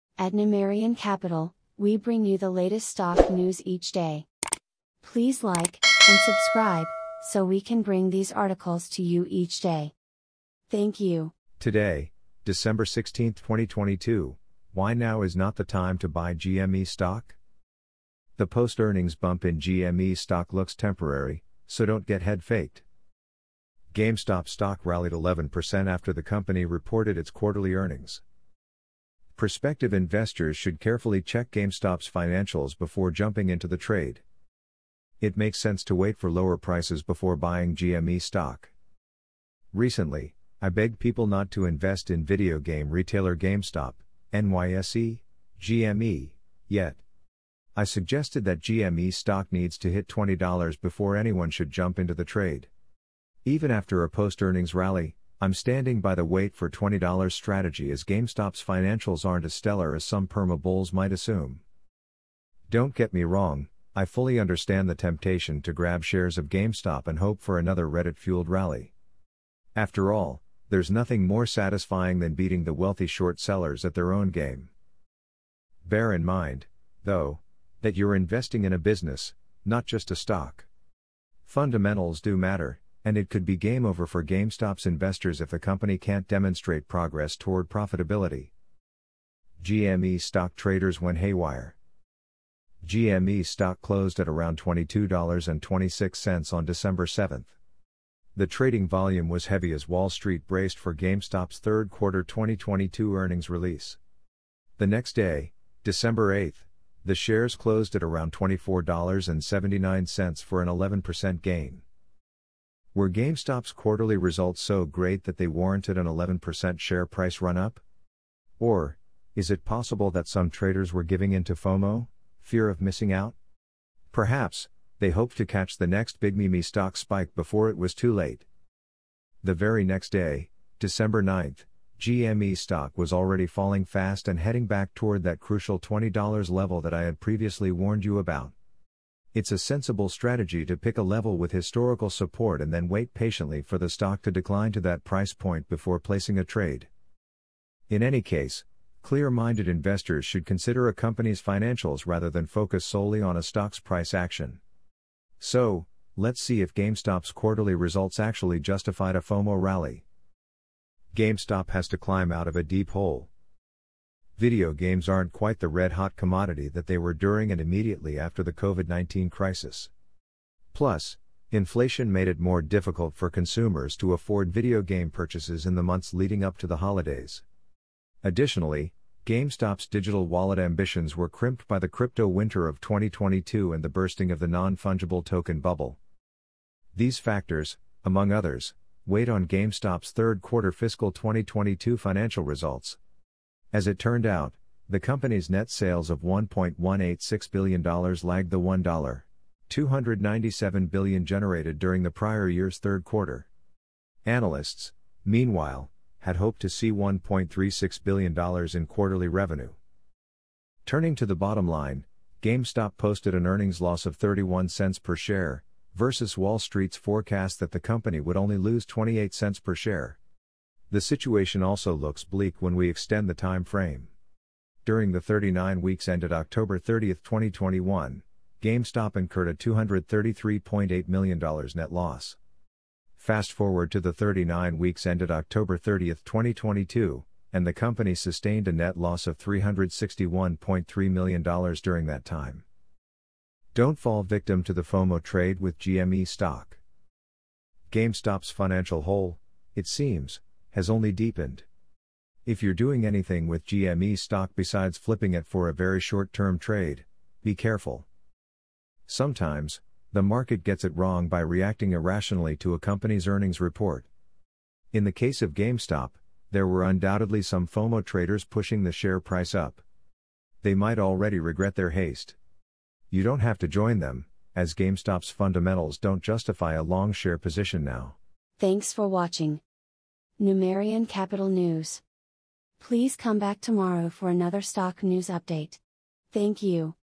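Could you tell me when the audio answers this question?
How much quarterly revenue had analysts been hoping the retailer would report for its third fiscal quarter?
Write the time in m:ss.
3:26.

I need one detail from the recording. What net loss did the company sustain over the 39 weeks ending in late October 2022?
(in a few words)
$361.3 million.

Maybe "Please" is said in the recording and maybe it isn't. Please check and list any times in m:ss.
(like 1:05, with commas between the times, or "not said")
0:05, 4:42.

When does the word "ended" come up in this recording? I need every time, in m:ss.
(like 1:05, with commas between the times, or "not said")
3:46, 3:55.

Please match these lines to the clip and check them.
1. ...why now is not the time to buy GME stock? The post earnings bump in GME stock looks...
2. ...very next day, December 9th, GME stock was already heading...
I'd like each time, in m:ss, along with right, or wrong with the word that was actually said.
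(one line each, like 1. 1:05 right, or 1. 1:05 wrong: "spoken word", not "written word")
1. 0:14 right
2. 2:09 wrong: "falling", not "heading".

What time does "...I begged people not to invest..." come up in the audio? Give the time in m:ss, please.
0:40.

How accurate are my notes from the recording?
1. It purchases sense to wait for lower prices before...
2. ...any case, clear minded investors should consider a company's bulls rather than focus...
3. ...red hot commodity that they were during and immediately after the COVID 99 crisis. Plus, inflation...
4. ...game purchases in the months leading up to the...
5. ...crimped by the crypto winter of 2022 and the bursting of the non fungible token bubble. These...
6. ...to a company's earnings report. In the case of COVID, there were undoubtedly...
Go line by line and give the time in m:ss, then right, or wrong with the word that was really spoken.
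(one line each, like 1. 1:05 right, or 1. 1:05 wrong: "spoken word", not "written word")
1. 0:35 wrong: "makes", not "purchases"
2. 2:28 wrong: "financials", not "bulls"
3. 2:45 wrong: "19", not "99"
4. 2:54 right
5. 3:01 right
6. 4:22 wrong: "GameStop", not "COVID".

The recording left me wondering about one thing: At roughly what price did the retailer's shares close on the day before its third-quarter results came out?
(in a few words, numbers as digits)
$22.26.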